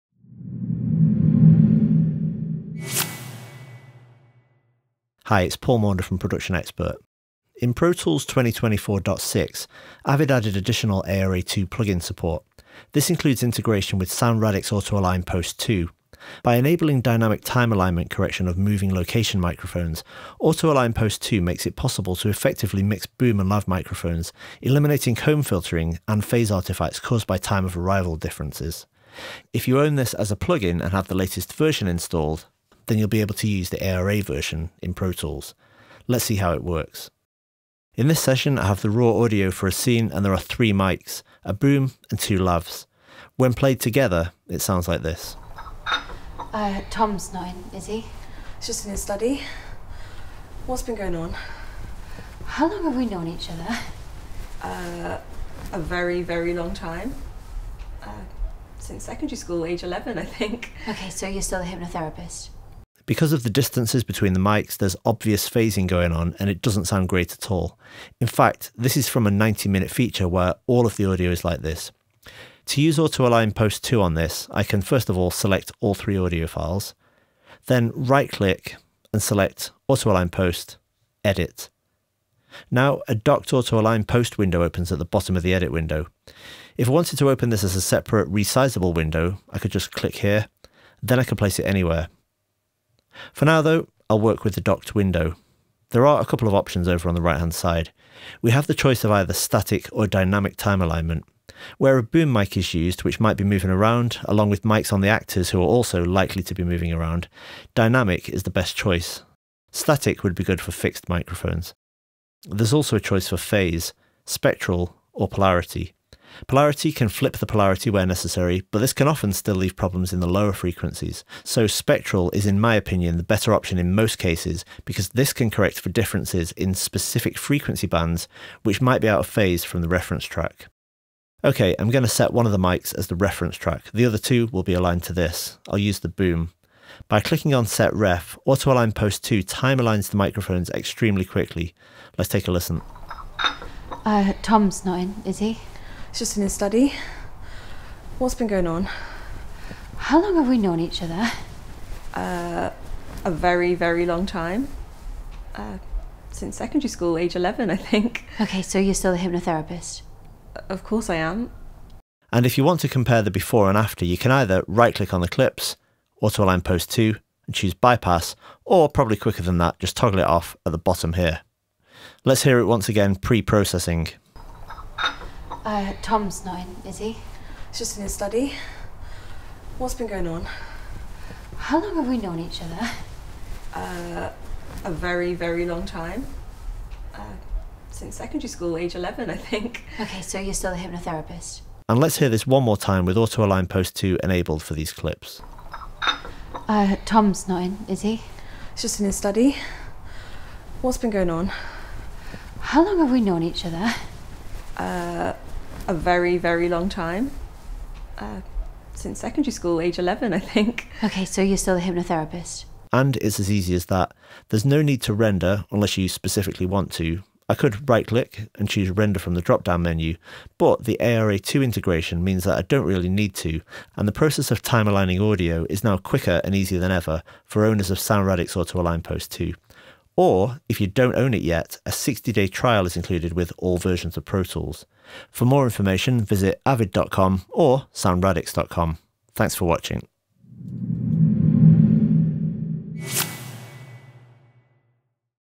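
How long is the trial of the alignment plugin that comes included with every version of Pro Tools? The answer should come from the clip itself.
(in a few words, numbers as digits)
60 days.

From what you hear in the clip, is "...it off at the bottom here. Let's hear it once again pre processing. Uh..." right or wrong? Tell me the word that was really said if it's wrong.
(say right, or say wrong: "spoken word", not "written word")
right.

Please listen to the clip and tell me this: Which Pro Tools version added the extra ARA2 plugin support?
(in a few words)
2024.6.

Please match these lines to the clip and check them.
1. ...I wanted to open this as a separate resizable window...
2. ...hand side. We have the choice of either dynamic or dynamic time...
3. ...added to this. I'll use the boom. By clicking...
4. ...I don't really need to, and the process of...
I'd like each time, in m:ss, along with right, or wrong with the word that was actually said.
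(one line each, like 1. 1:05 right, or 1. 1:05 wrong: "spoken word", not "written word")
1. 1:26 right
2. 1:37 wrong: "static", not "dynamic"
3. 2:14 wrong: "aligned", not "added"
4. 3:42 right.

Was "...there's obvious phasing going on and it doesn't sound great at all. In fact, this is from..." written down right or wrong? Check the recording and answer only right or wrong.
right.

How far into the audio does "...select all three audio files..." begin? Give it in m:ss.
1:15.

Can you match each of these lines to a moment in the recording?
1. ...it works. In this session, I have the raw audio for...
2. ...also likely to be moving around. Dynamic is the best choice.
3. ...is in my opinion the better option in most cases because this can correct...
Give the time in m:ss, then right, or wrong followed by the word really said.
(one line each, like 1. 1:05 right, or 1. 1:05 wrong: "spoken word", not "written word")
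1. 0:36 right
2. 1:45 right
3. 2:02 right.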